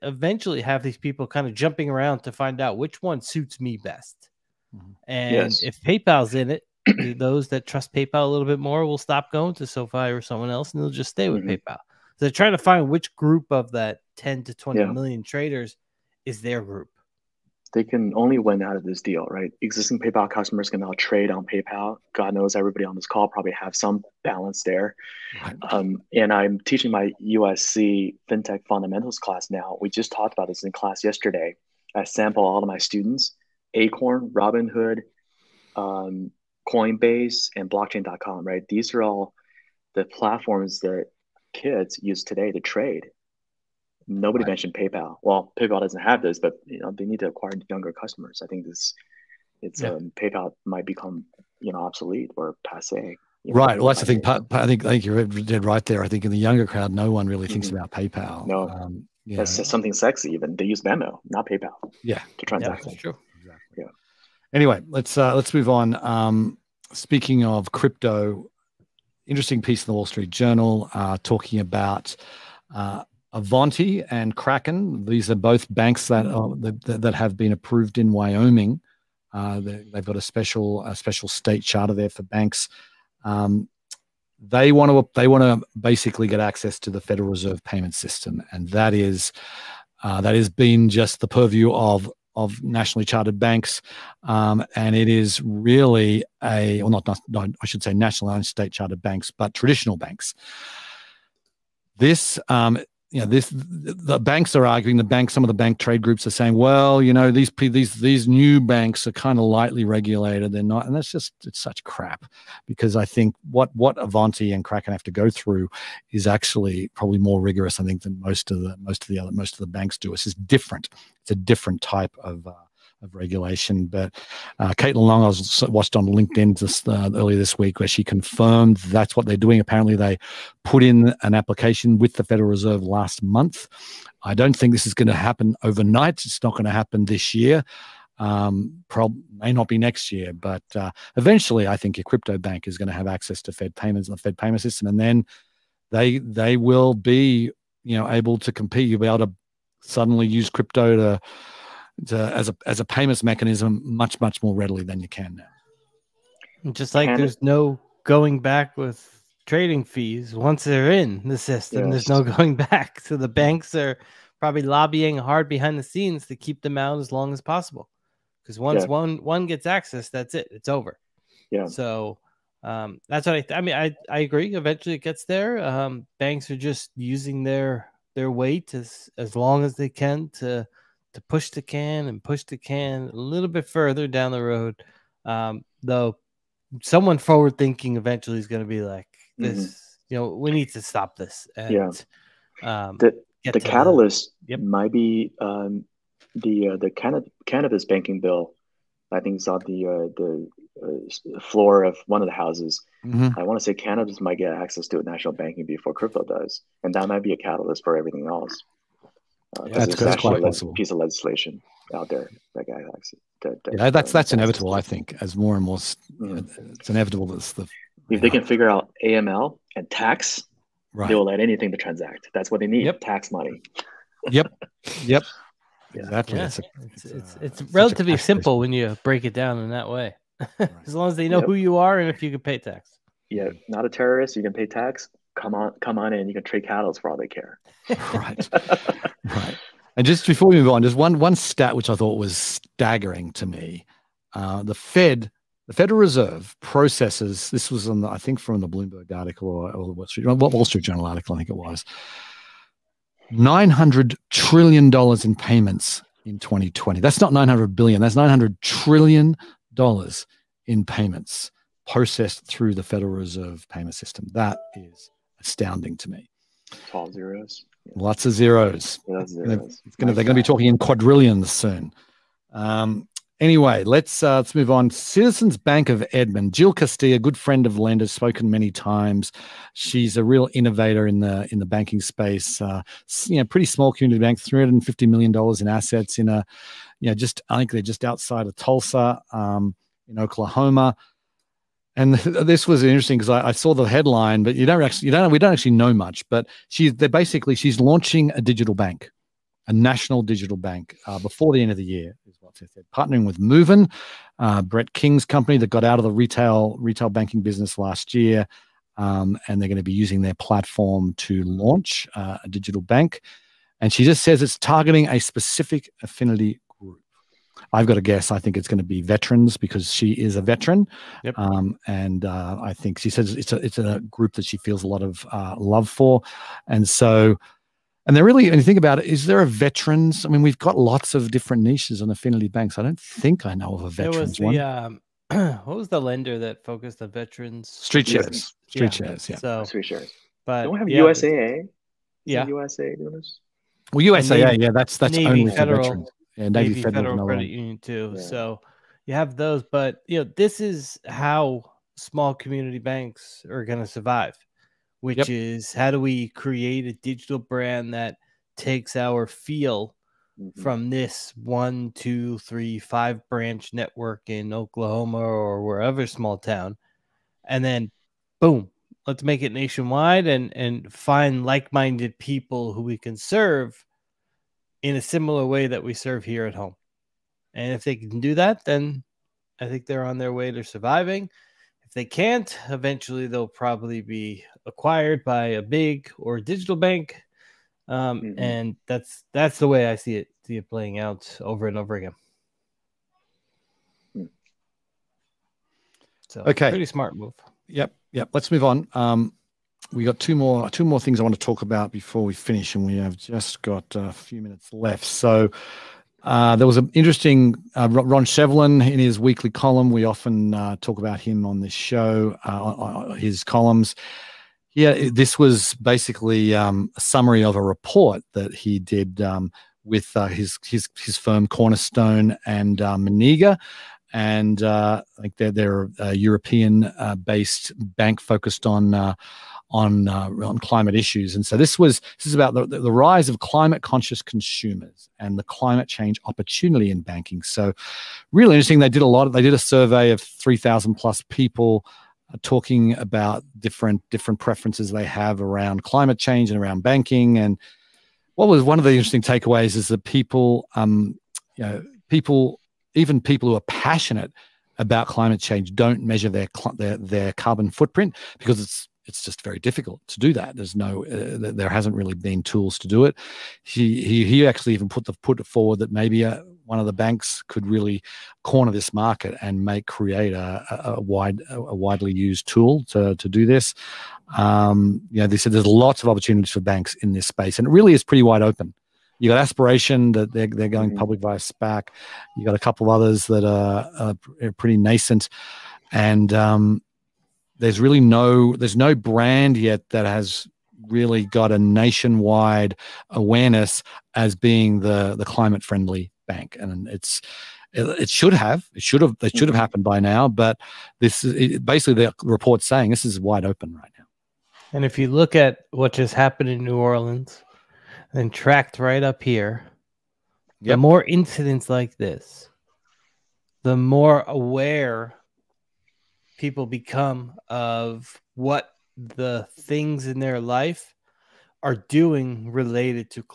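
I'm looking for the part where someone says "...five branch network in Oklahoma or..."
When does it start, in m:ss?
6:02.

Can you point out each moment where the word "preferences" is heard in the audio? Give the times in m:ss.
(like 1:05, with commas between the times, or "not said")
7:24.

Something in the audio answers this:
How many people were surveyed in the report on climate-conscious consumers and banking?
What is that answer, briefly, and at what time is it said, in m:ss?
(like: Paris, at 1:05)
3,000+, at 7:20.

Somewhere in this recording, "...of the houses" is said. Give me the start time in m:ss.
3:22.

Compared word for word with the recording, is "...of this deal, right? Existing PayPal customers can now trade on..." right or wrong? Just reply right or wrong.
right.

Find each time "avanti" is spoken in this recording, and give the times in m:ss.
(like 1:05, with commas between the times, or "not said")
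1:13, 1:53.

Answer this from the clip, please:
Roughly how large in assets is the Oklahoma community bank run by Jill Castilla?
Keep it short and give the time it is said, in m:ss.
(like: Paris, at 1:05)
$350 million, at 4:44.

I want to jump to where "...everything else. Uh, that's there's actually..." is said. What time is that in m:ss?
3:27.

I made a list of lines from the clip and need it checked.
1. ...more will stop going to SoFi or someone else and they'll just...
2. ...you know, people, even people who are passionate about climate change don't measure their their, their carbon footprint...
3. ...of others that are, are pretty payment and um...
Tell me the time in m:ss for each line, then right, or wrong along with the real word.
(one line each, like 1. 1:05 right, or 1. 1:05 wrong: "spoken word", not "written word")
1. 0:08 right
2. 7:31 right
3. 8:02 wrong: "nascent", not "payment".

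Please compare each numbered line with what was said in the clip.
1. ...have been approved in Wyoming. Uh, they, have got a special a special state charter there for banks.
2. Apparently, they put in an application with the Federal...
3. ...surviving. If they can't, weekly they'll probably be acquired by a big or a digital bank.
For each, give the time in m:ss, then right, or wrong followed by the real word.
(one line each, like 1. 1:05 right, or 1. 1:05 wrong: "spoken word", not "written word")
1. 1:17 right
2. 2:09 right
3. 6:20 wrong: "eventually", not "weekly".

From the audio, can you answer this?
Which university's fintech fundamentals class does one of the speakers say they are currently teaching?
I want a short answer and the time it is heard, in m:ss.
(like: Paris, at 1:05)
USC, at 0:27.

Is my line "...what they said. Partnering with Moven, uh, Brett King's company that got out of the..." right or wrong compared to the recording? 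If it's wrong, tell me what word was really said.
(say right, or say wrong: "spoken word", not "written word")
right.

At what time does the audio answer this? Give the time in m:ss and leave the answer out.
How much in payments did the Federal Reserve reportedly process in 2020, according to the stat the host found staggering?
4:13.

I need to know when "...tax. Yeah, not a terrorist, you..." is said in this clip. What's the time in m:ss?
3:52.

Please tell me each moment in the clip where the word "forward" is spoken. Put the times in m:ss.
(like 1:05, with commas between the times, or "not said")
3:07, 7:45.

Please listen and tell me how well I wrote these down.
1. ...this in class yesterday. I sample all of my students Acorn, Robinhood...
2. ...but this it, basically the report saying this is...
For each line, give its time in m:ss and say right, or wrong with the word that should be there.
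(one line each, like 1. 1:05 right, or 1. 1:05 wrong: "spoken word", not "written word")
1. 0:30 right
2. 8:20 right.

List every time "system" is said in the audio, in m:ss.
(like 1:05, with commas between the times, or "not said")
1:27, 2:24, 2:41, 4:23.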